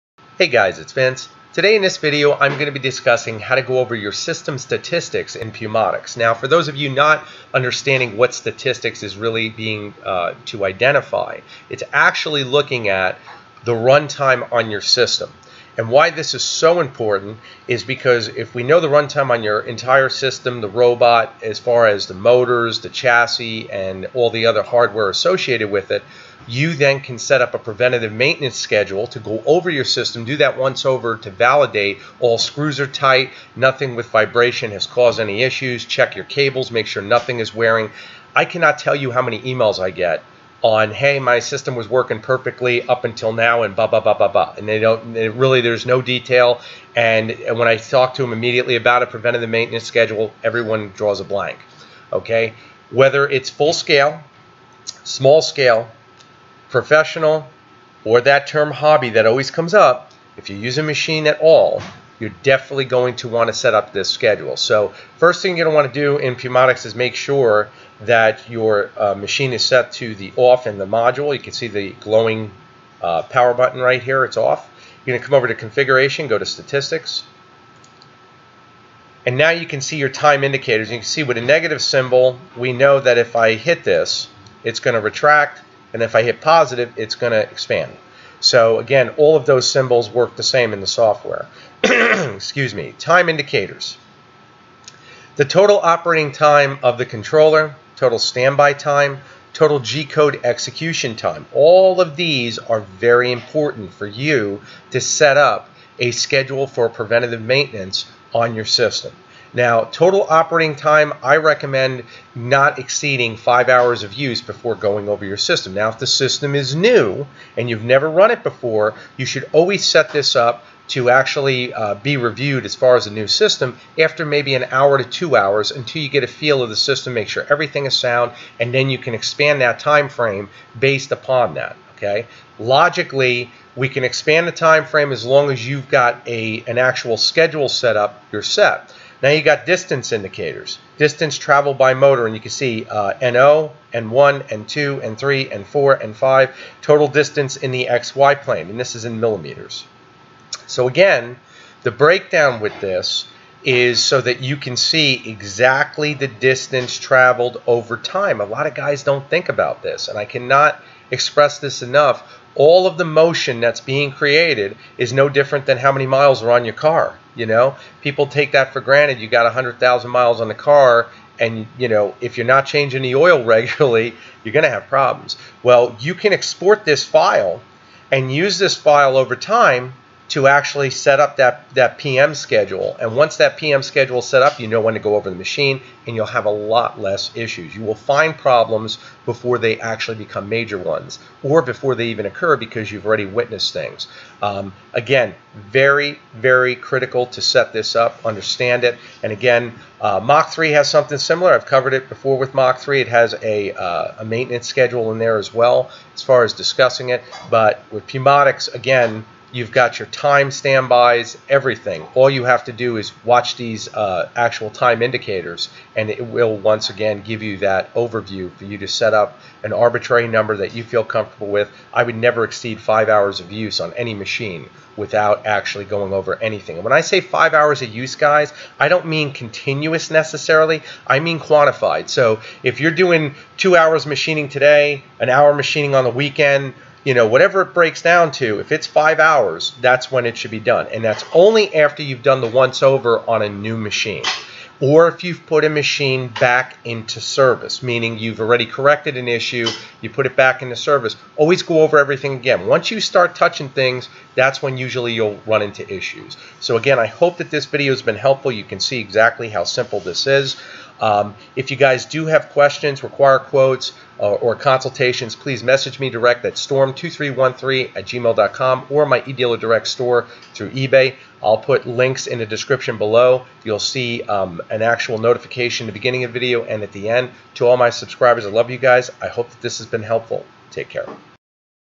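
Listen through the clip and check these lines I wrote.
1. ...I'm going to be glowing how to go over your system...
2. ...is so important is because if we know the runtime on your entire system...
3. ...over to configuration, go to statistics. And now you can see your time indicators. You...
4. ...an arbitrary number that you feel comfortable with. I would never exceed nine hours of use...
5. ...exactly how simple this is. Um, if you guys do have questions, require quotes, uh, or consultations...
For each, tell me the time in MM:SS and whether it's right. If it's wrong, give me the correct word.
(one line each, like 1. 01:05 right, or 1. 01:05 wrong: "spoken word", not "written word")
1. 00:02 wrong: "discussing", not "glowing"
2. 00:16 right
3. 01:15 right
4. 03:39 wrong: "five", not "nine"
5. 04:18 right.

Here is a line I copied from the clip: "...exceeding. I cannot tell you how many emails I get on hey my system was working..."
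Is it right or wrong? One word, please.
wrong.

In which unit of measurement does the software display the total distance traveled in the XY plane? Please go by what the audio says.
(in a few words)
millimeters.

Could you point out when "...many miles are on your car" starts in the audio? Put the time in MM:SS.
02:45.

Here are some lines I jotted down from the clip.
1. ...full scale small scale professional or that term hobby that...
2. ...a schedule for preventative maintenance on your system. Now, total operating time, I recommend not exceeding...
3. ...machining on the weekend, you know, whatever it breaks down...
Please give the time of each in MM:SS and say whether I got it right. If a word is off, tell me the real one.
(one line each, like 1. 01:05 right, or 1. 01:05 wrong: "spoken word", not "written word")
1. 00:53 right
2. 01:45 right
3. 03:55 right.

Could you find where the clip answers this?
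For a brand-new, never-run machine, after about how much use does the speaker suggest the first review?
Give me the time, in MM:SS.
02:04.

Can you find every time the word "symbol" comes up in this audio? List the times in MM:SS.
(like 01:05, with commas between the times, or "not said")
01:21, 01:29.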